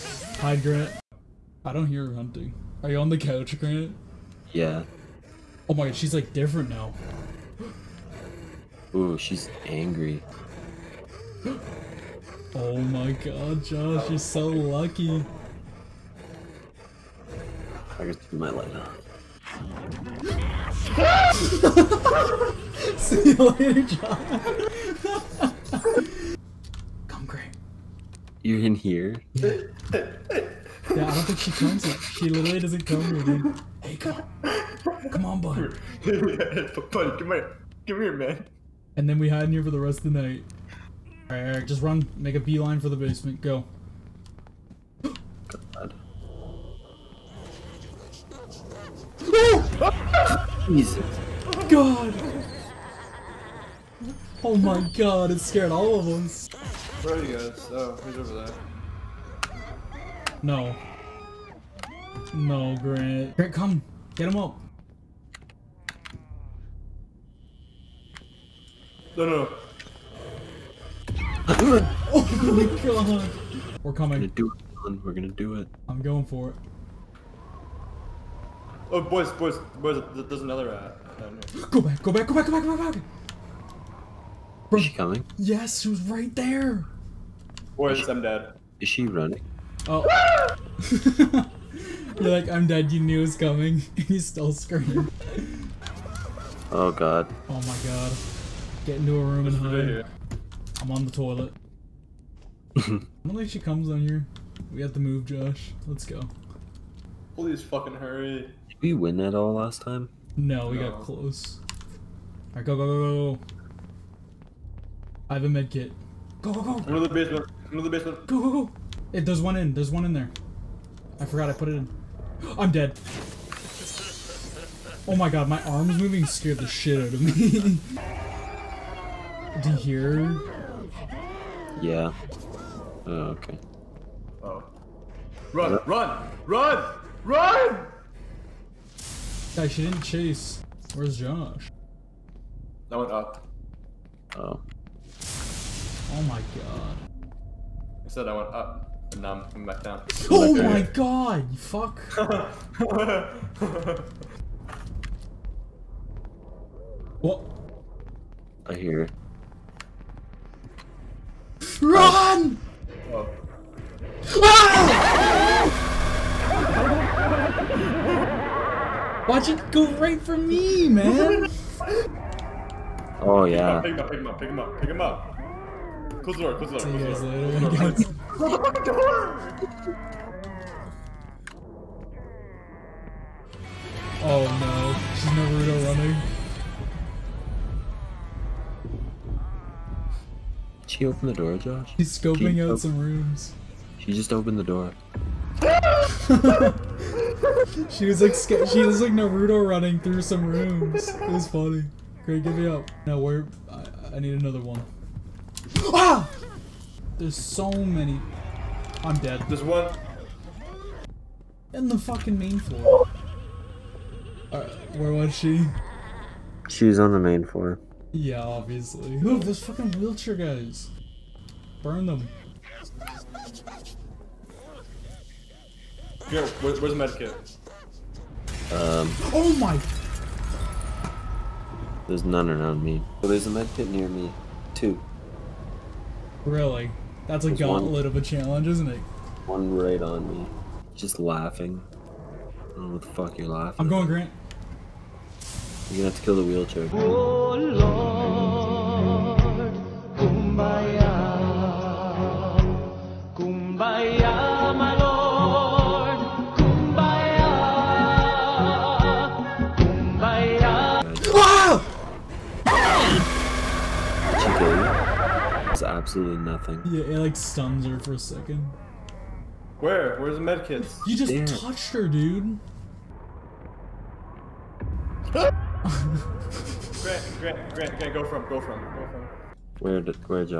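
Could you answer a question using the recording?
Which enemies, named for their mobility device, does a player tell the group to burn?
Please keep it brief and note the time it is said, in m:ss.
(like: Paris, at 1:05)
Wheelchair guys, at 3:39.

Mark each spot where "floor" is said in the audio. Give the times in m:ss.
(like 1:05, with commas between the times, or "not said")
3:32, 3:37.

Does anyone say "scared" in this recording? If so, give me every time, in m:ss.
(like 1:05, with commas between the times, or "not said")
0:55, 2:06.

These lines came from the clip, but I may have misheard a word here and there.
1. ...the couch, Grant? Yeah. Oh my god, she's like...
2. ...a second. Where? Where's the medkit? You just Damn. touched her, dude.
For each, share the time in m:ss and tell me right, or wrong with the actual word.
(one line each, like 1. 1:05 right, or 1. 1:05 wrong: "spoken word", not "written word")
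1. 0:03 right
2. 4:28 right.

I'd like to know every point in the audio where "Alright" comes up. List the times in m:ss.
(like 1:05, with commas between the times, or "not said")
0:41, 1:52.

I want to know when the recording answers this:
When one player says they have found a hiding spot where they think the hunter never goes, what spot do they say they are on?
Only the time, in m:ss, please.
1:40.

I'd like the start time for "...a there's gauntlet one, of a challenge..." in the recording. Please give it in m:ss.
3:57.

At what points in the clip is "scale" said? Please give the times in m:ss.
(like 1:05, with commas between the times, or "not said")
not said.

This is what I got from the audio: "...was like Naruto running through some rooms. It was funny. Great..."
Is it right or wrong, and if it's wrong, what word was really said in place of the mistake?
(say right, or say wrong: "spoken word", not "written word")
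right.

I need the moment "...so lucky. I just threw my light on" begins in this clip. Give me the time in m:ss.
0:14.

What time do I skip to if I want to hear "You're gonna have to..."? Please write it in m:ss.
4:05.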